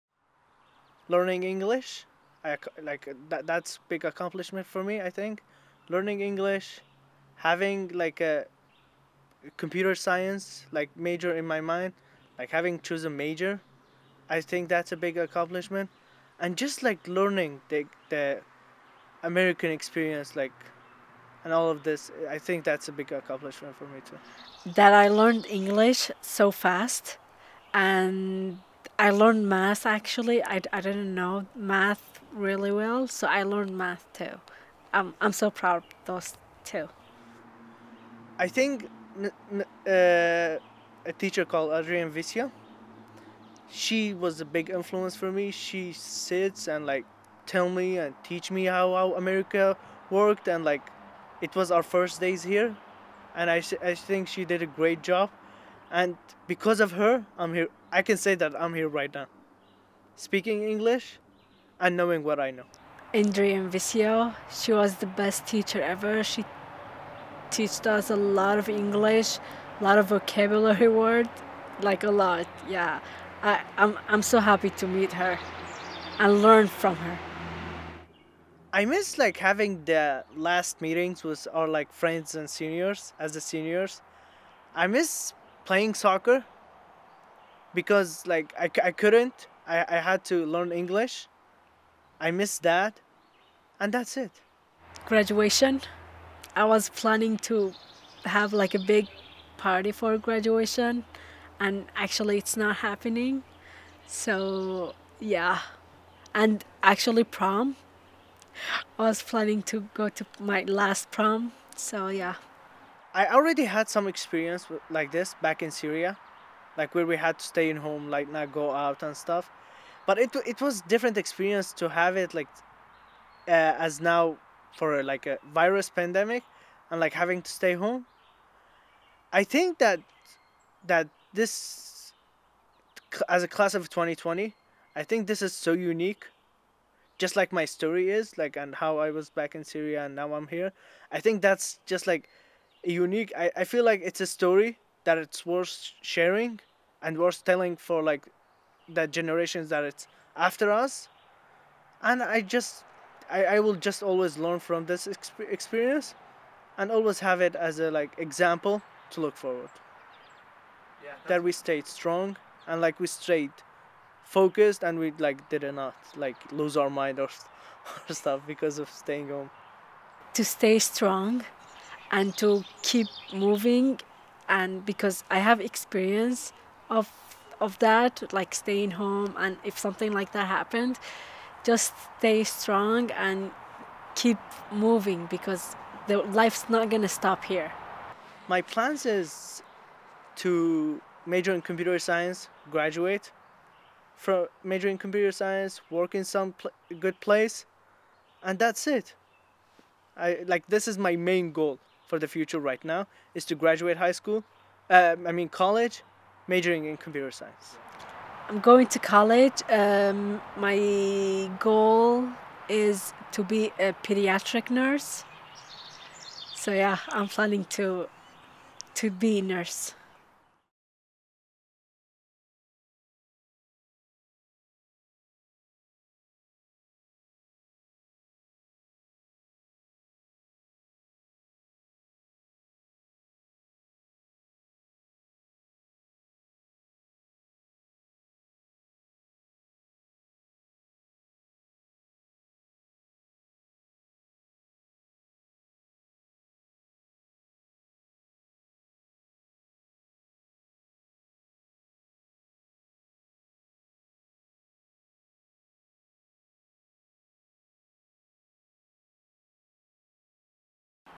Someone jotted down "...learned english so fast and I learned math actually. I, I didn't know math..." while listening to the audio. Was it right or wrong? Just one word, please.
right.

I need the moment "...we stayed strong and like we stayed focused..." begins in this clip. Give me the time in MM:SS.
02:41.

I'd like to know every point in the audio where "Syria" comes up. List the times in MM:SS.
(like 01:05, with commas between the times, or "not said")
01:55, 02:19.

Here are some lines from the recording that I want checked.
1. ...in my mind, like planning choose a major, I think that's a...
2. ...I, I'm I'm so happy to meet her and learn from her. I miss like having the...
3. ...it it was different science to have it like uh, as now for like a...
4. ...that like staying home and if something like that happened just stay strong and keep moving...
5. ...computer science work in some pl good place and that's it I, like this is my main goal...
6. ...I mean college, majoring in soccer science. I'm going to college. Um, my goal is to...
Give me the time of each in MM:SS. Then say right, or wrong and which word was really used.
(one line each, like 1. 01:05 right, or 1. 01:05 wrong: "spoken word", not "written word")
1. 00:11 wrong: "having", not "planning"
2. 01:13 right
3. 02:00 wrong: "experience", not "science"
4. 02:57 right
5. 03:14 right
6. 03:25 wrong: "computer", not "soccer".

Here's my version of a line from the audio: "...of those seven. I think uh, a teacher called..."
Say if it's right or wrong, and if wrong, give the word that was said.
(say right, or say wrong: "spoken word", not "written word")
wrong: "two", not "seven".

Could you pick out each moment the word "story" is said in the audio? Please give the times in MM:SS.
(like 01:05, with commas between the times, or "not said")
02:17, 02:24.